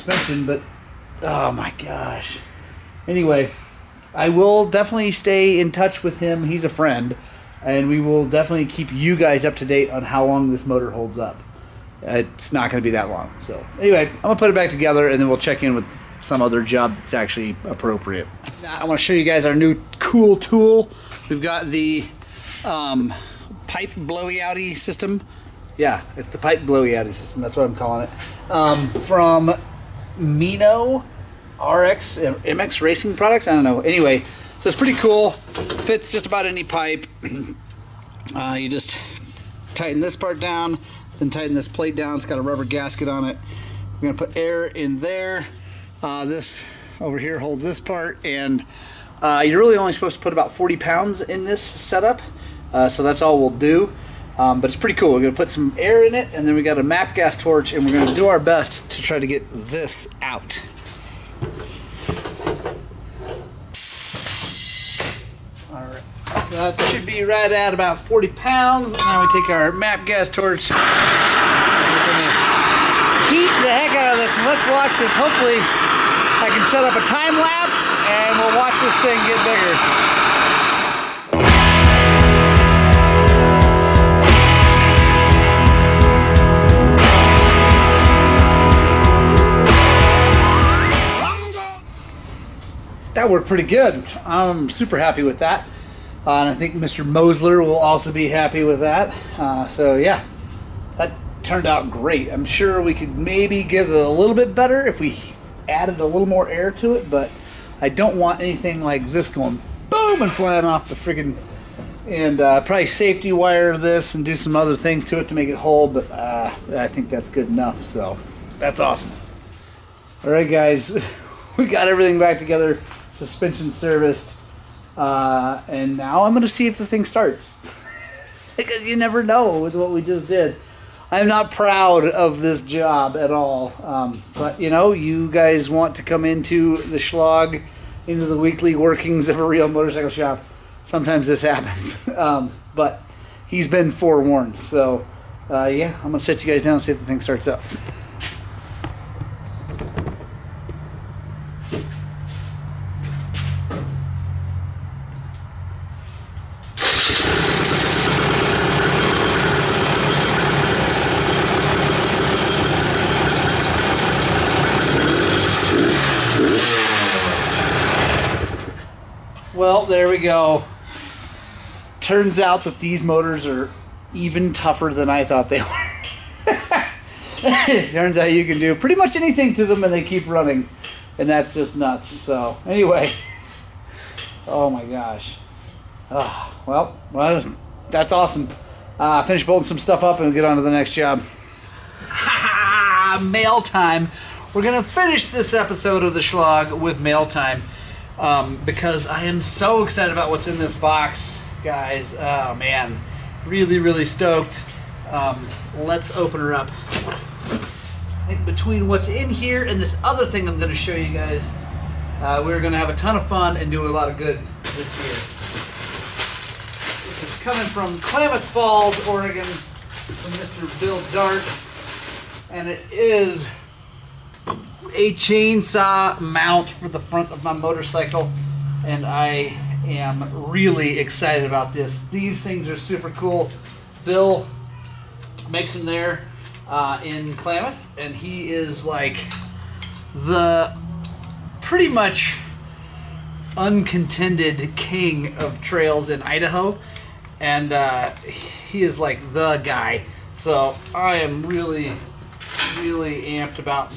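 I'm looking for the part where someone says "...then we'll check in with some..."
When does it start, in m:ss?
0:15.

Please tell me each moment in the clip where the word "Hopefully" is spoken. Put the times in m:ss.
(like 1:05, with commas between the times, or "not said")
1:15.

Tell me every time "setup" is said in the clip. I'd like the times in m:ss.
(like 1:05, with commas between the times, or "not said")
0:51.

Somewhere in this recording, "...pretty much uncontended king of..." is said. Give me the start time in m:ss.
4:01.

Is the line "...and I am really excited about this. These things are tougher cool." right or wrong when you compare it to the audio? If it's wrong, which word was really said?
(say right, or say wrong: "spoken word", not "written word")
wrong: "super", not "tougher".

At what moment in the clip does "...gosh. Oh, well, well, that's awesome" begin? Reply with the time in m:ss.
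3:04.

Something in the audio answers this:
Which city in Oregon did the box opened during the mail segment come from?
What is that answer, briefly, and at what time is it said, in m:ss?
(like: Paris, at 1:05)
Klamath Falls, at 3:38.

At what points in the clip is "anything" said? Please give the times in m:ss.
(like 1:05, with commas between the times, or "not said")
1:48, 2:59.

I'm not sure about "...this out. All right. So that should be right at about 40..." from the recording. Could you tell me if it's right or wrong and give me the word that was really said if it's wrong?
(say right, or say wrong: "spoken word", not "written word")
right.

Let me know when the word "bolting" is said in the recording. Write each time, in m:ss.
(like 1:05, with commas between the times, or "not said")
3:09.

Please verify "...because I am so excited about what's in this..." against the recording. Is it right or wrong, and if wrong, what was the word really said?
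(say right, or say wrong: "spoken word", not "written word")
right.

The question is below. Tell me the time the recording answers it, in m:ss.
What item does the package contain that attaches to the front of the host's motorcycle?
3:45.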